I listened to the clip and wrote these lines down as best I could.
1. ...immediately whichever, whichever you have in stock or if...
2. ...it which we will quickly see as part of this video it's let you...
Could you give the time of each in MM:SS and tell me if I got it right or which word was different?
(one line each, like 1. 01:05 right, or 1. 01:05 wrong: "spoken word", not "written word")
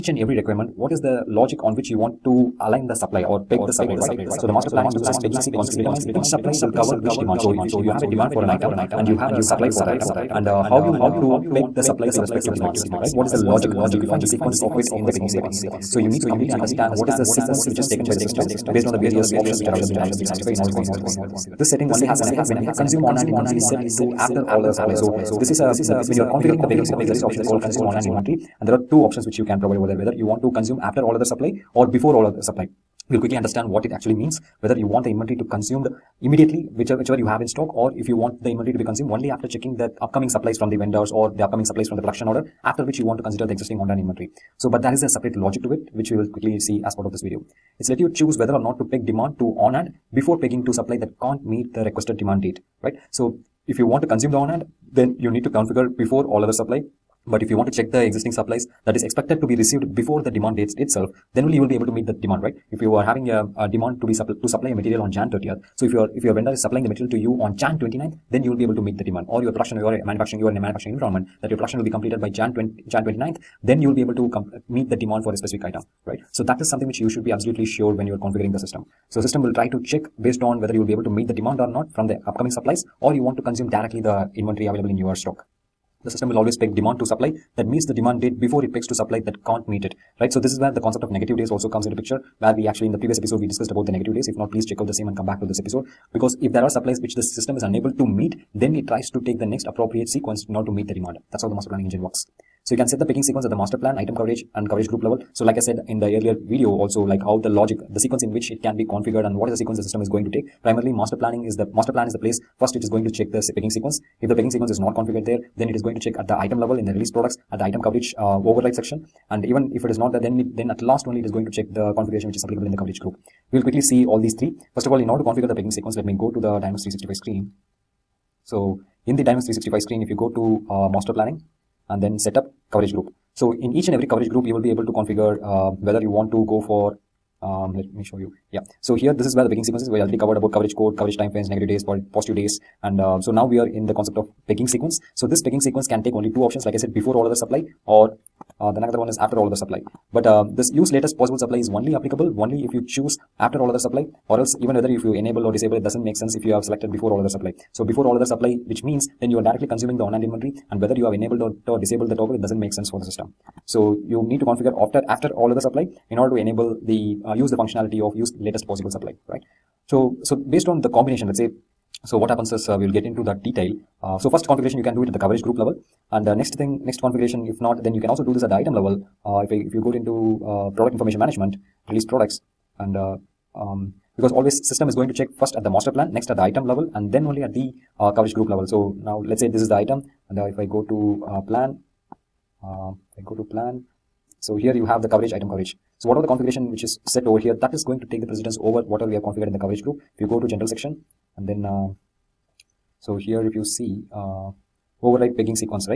1. 00:36 right
2. 00:45 right.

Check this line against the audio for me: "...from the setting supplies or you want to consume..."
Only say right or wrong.
wrong.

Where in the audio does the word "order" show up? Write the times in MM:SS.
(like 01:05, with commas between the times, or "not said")
00:20, 00:42, 01:40, 02:05, 02:46.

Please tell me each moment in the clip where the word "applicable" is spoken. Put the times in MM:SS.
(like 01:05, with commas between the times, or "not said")
02:02, 02:31.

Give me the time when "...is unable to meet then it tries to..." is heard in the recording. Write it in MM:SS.
01:37.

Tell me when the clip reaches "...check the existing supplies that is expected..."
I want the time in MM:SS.
00:57.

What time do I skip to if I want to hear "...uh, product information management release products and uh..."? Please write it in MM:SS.
03:00.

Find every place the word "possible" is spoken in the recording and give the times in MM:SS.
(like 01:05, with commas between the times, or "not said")
02:31, 02:48.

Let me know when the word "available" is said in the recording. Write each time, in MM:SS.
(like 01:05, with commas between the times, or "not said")
00:19, 01:24.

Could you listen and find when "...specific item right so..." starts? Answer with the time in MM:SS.
01:15.